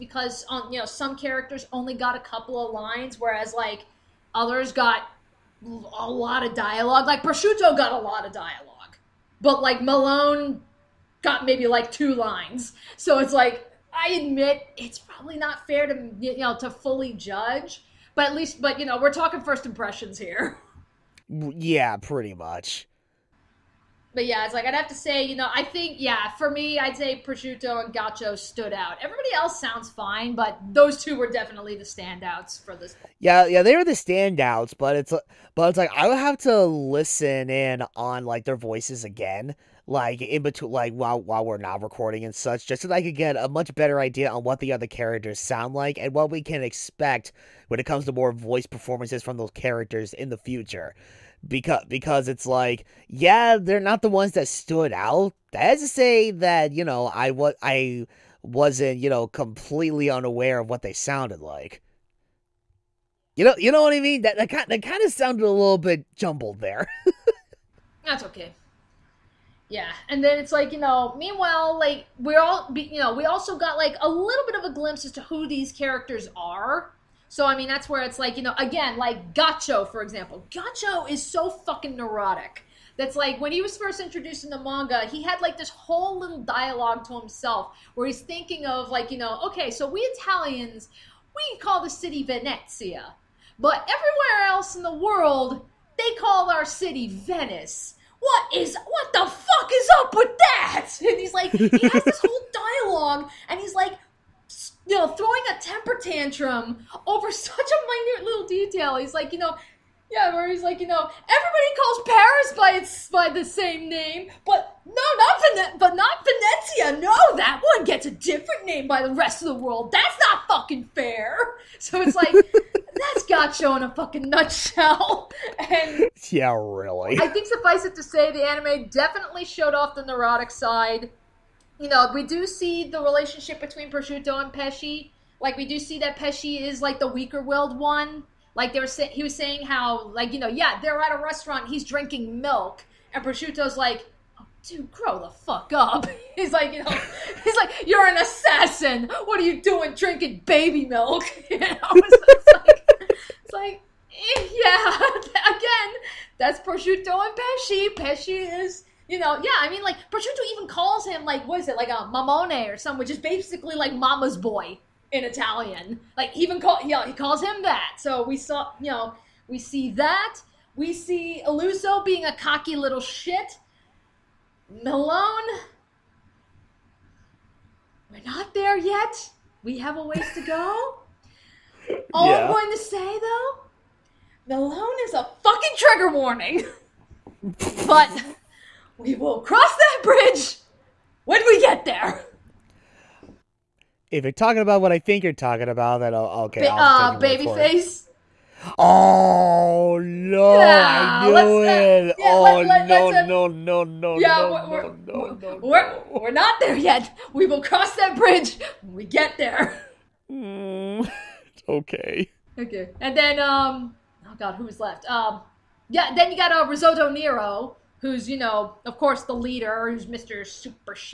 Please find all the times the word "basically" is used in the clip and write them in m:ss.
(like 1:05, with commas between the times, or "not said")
2:43.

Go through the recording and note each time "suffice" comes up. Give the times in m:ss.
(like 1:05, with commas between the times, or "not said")
2:07.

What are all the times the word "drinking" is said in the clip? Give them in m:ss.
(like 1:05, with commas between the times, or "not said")
2:21, 2:29.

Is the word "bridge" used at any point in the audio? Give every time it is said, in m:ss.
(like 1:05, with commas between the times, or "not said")
3:10, 3:28.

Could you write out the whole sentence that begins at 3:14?
If you're talking about what I think you're talking about, then I'll, okay.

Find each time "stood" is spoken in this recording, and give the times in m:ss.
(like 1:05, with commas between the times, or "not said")
0:28, 0:54.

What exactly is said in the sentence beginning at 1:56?
No, that one gets a different name by the rest of the world.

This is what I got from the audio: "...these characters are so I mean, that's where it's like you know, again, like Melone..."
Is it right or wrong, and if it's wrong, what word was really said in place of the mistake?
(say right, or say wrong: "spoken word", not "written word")
wrong: "Ghiaccio", not "Melone".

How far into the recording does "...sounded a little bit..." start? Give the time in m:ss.
1:05.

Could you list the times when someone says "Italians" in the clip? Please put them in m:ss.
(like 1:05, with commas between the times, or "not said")
1:30, 2:45.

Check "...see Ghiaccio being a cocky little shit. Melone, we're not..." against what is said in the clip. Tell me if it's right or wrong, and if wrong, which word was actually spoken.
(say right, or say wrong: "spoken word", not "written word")
wrong: "Illuso", not "Ghiaccio".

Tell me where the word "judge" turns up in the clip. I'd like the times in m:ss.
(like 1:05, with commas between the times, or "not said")
0:17.